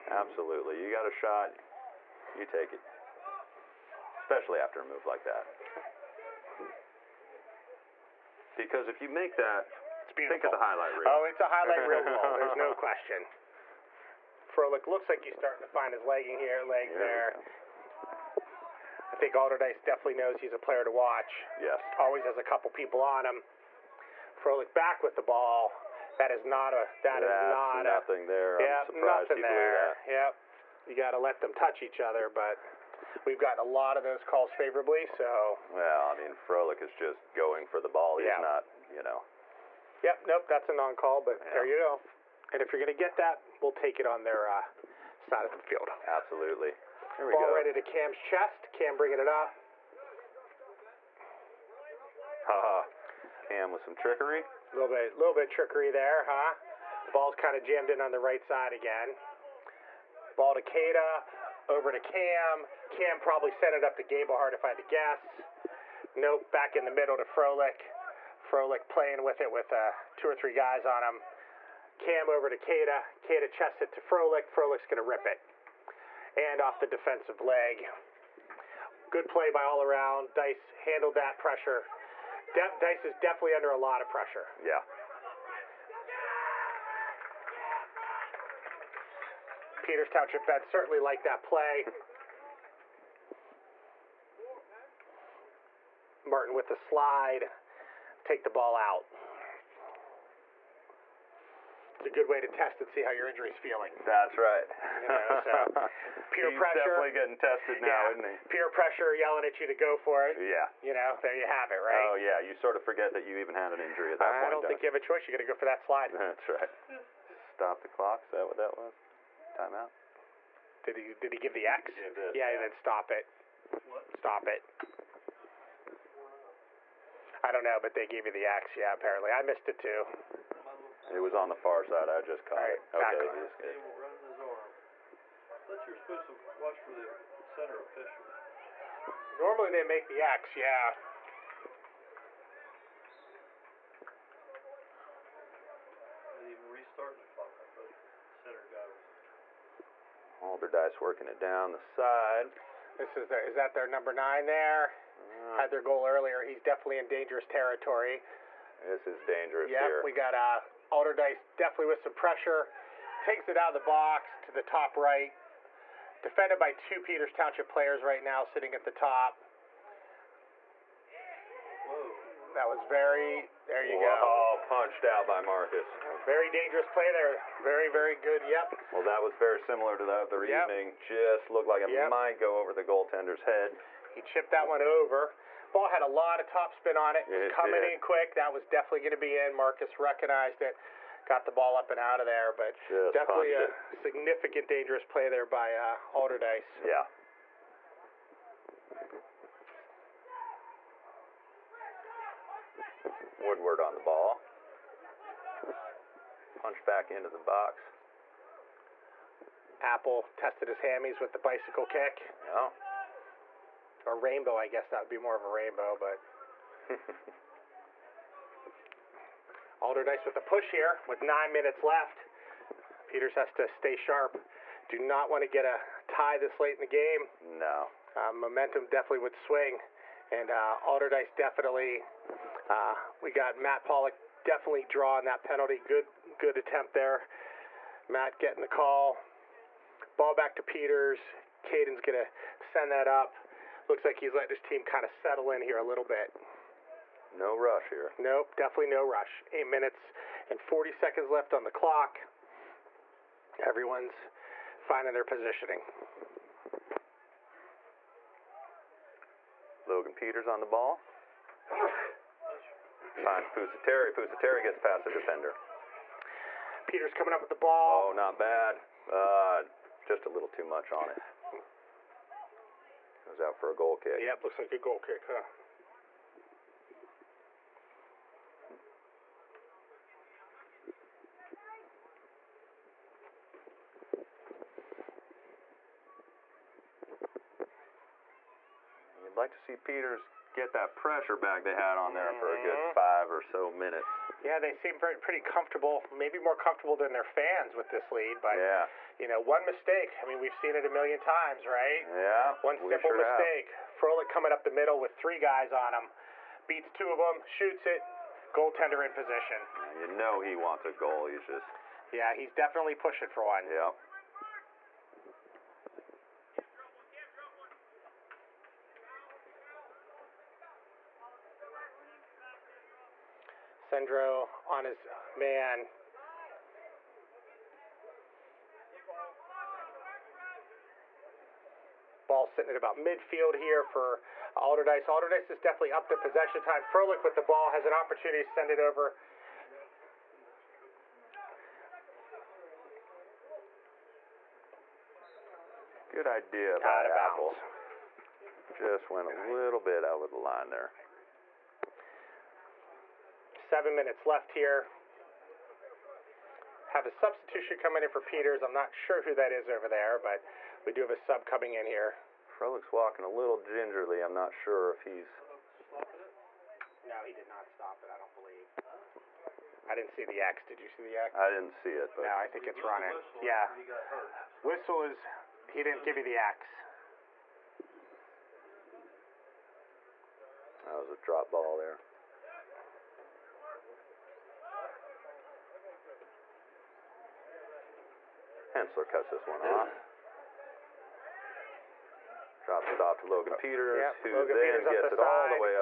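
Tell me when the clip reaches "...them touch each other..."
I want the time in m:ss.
0:31.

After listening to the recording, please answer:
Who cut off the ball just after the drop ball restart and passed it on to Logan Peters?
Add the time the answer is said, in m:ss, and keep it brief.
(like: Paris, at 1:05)
Hensler, at 6:28.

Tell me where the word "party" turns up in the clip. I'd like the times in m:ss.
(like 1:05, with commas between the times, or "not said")
not said.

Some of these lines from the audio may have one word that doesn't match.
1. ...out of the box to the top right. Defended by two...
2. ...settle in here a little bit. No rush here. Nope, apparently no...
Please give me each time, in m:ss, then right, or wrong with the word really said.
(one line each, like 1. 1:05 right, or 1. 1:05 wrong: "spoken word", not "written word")
1. 2:43 right
2. 4:05 wrong: "definitely", not "apparently".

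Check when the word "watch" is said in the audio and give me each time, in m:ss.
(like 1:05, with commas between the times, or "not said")
0:20, 2:16.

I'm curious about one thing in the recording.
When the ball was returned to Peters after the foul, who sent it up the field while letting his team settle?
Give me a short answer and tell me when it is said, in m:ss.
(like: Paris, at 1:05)
Caden, at 4:01.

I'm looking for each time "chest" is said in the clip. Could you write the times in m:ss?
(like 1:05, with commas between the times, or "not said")
0:48, 1:13.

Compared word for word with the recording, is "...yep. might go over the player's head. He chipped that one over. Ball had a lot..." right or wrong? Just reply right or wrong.
wrong.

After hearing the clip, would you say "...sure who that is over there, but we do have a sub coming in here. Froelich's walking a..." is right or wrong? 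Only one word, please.
right.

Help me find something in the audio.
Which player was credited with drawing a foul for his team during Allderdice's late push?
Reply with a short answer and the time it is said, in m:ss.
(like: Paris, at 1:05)
Matt Pollock, at 3:53.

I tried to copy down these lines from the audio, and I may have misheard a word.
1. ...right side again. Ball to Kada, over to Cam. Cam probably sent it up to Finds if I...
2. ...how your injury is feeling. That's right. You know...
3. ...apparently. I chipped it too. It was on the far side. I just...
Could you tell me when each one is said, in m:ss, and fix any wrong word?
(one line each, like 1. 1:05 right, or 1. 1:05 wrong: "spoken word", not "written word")
1. 0:58 wrong: "Gablehart", not "Finds"
2. 1:43 right
3. 2:08 wrong: "missed", not "chipped".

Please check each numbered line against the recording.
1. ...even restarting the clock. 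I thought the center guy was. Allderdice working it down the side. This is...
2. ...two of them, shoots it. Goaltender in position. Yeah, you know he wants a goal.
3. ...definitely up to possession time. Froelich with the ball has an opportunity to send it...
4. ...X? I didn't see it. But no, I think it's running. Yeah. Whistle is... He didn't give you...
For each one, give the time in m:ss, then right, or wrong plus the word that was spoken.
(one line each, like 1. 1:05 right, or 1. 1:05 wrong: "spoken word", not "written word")
1. 2:26 right
2. 5:06 right
3. 5:35 right
4. 6:11 right.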